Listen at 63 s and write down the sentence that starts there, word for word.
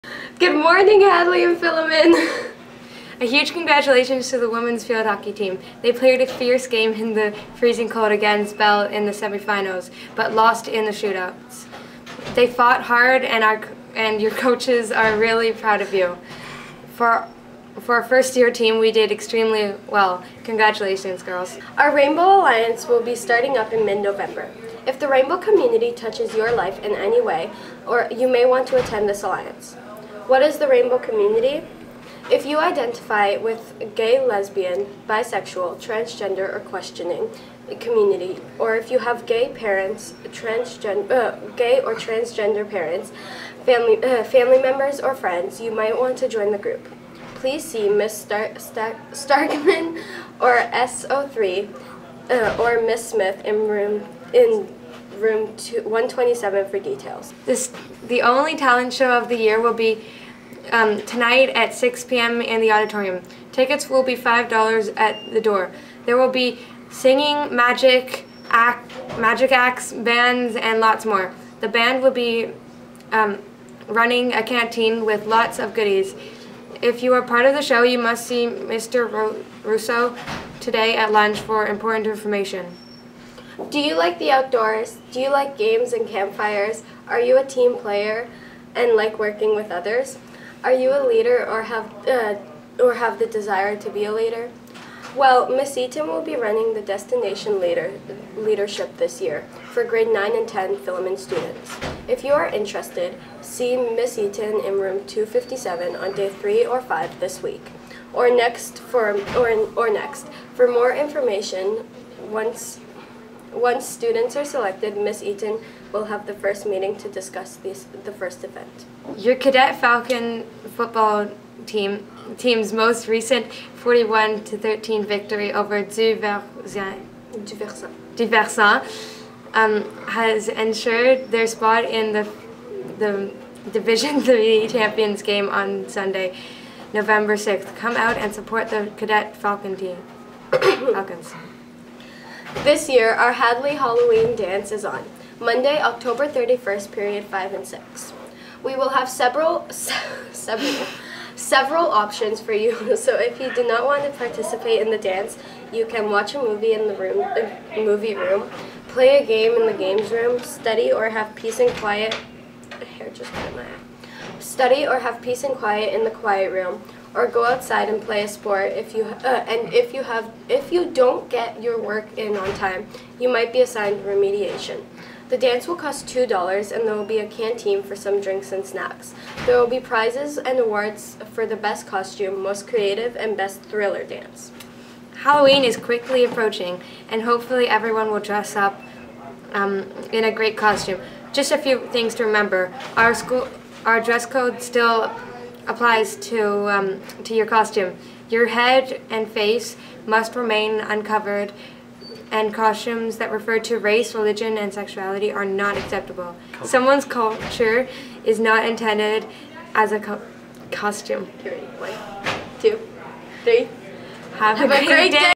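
Tickets will be $5 at the door.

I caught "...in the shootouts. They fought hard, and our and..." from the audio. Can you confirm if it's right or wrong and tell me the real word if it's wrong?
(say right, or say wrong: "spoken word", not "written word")
right.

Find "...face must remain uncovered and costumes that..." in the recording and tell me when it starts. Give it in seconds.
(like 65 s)
199 s.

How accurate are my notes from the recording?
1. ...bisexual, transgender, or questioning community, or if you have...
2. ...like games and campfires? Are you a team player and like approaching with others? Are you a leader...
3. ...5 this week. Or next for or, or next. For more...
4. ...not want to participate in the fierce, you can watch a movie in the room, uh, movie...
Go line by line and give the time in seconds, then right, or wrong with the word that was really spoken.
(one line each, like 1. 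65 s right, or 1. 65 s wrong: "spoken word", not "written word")
1. 35 s right
2. 85 s wrong: "working", not "approaching"
3. 106 s right
4. 153 s wrong: "dance", not "fierce".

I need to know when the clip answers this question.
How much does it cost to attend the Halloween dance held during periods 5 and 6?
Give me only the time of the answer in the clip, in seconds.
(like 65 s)
176 s.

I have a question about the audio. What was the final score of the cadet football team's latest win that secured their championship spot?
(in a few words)
41 to 13.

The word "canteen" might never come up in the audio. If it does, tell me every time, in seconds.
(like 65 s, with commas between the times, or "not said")
74 s, 177 s.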